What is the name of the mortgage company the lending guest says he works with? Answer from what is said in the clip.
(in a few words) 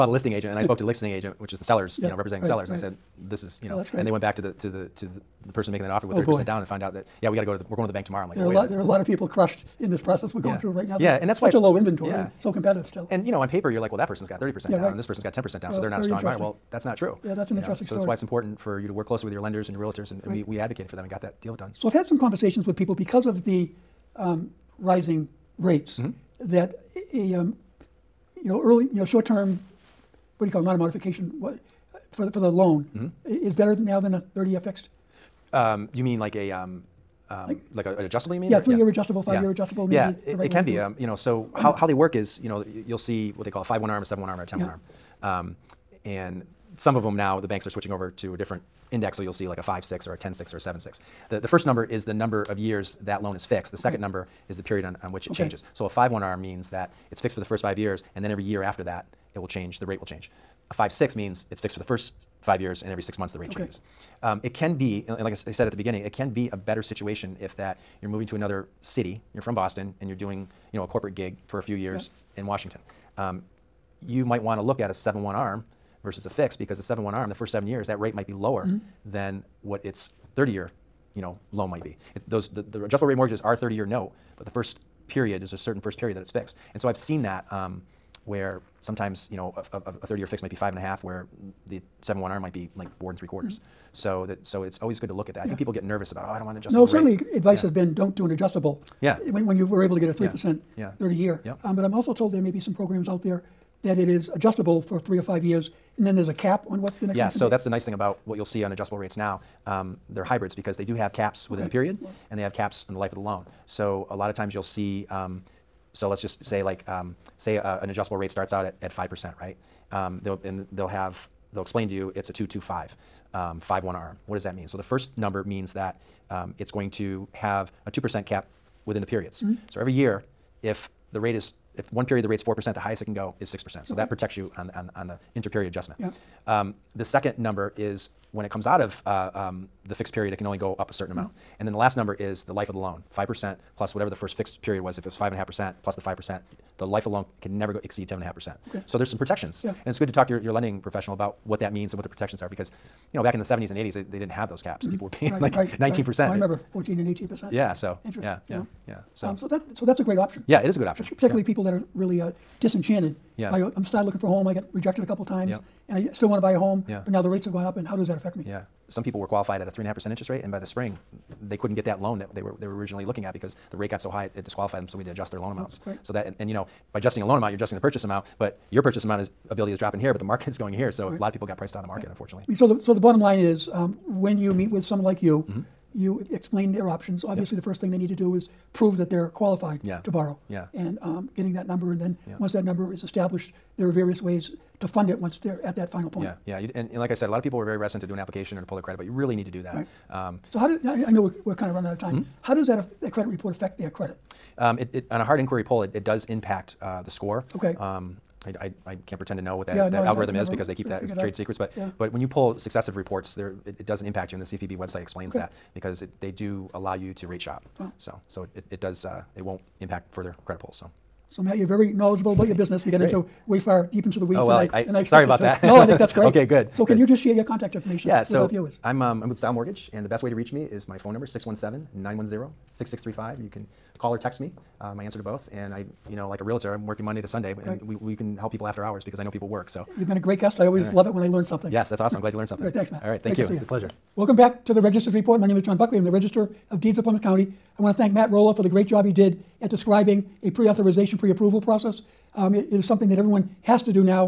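Style Mortgage.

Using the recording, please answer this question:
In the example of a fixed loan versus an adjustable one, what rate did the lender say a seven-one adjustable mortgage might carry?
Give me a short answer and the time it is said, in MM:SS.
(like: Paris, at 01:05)
4.75%, at 01:32.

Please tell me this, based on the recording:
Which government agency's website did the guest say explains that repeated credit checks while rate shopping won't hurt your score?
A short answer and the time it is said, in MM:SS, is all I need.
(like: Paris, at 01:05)
CFPB, at 03:34.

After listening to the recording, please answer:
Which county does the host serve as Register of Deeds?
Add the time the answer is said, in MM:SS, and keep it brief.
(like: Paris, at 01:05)
Plymouth County, at 04:07.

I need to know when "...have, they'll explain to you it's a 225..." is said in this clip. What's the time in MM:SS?
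02:00.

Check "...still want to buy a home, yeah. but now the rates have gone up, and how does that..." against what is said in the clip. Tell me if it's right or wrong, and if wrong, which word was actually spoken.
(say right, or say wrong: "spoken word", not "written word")
right.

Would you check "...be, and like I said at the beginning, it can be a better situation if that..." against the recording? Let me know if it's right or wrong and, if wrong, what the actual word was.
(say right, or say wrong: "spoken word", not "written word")
right.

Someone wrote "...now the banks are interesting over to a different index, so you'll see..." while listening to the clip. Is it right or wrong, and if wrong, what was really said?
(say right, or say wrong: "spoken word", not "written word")
wrong: "switching", not "interesting".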